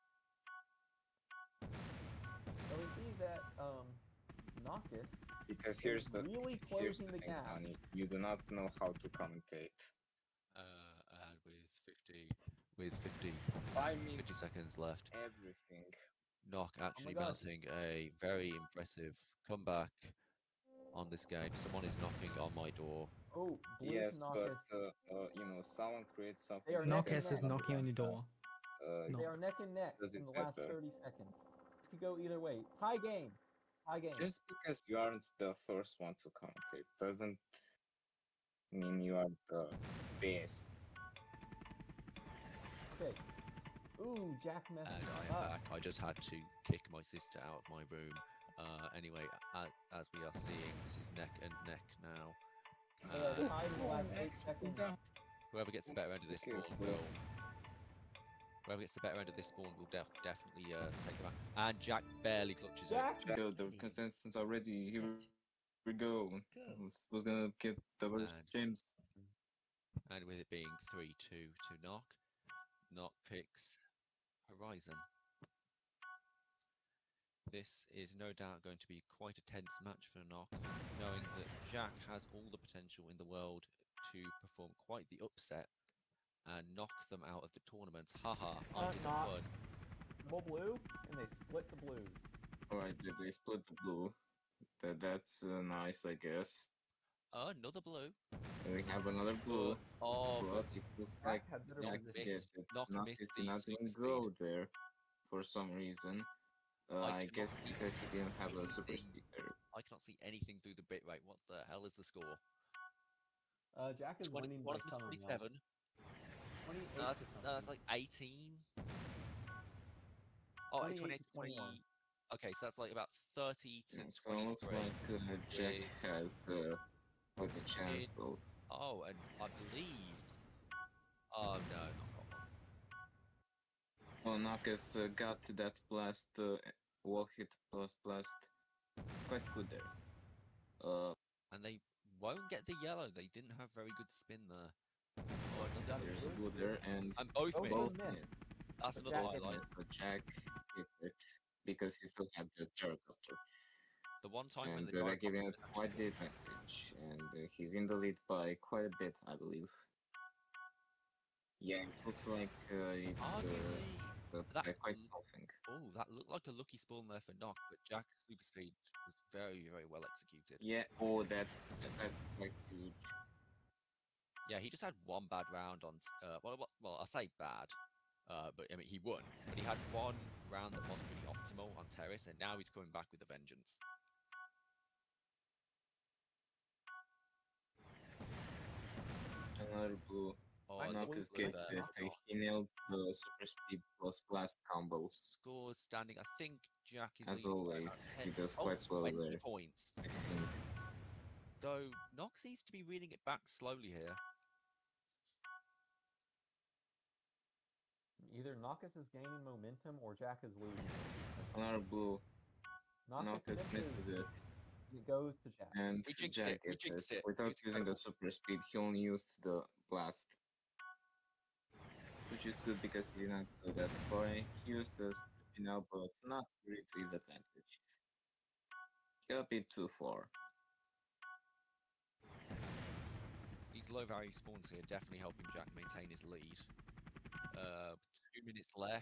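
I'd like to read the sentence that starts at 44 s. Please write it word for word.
Ooh, Jack messed and I, am back.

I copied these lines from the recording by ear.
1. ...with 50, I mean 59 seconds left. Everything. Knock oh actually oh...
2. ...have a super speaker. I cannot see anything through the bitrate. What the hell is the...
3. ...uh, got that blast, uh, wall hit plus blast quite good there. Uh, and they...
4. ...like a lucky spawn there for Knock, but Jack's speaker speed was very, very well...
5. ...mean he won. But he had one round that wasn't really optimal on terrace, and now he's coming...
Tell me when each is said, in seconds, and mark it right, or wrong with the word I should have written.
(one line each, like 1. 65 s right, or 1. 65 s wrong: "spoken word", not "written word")
1. 12 s wrong: "50", not "59"
2. 108 s right
3. 134 s right
4. 166 s wrong: "super", not "speaker"
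5. 178 s right.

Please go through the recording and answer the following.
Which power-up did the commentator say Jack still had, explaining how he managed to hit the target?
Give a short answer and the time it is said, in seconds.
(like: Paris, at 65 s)
gyrocopter, at 152 s.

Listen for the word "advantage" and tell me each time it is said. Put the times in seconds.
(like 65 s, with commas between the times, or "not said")
156 s, 227 s.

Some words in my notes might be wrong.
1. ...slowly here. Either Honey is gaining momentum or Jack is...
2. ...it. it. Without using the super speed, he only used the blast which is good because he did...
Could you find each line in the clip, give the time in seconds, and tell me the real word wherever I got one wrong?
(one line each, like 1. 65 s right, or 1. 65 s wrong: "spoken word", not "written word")
1. 203 s wrong: "Nockess", not "Honey"
2. 217 s right.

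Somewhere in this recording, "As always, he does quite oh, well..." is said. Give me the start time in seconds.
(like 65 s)
197 s.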